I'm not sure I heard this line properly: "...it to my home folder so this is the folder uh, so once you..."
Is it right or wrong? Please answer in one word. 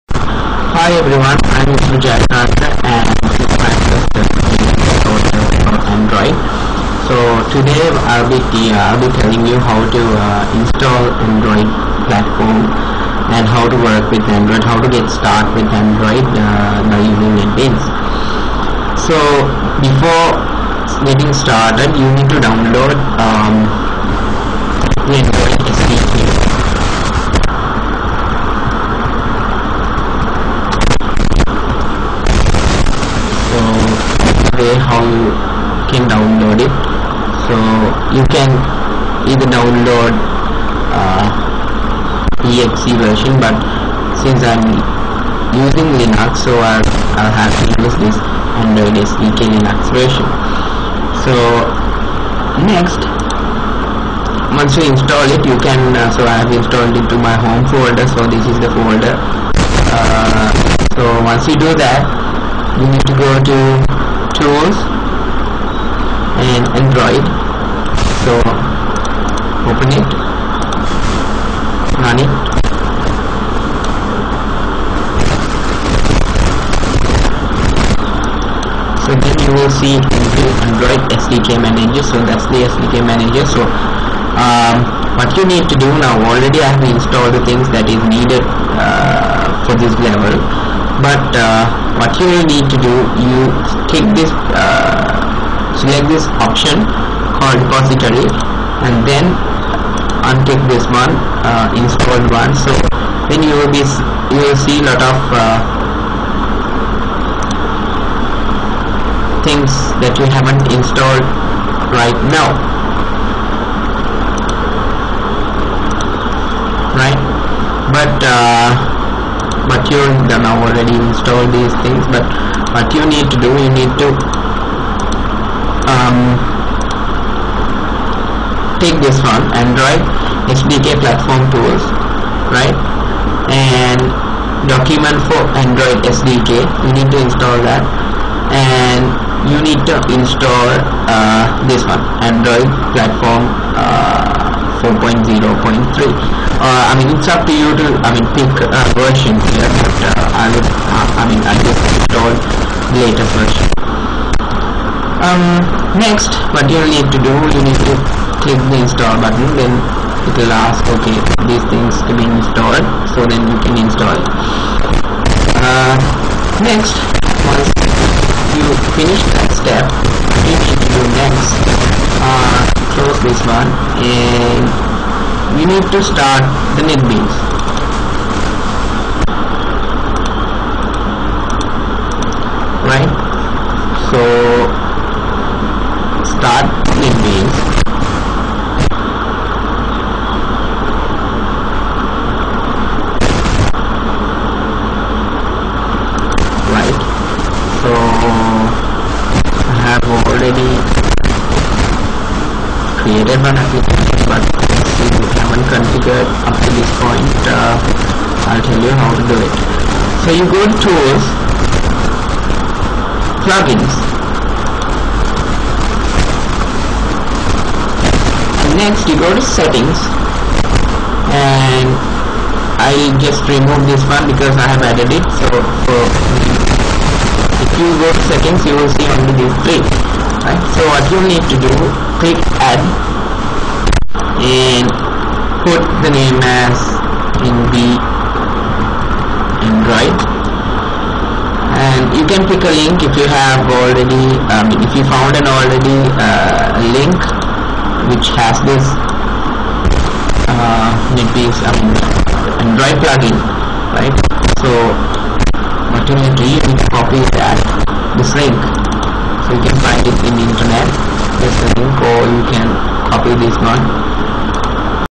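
right.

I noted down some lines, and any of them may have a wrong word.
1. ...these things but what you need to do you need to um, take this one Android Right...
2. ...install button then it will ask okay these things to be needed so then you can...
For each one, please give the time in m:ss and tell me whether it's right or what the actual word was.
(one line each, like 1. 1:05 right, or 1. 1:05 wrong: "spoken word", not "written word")
1. 2:01 wrong: "SDK", not "Right"
2. 2:38 wrong: "installed", not "needed".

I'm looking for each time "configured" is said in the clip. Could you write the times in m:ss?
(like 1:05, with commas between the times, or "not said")
3:25.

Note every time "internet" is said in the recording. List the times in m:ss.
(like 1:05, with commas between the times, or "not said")
4:20.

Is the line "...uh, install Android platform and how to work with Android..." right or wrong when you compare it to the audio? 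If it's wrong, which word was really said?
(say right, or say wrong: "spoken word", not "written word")
right.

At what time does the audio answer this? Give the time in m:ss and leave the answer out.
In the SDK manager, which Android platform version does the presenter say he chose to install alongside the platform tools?
2:24.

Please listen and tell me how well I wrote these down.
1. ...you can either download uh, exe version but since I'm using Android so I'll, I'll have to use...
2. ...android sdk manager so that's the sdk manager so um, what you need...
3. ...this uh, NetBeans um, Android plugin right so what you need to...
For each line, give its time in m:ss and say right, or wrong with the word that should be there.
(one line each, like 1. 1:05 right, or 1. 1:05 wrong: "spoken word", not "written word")
1. 0:38 wrong: "Linux", not "Android"
2. 1:19 right
3. 4:08 right.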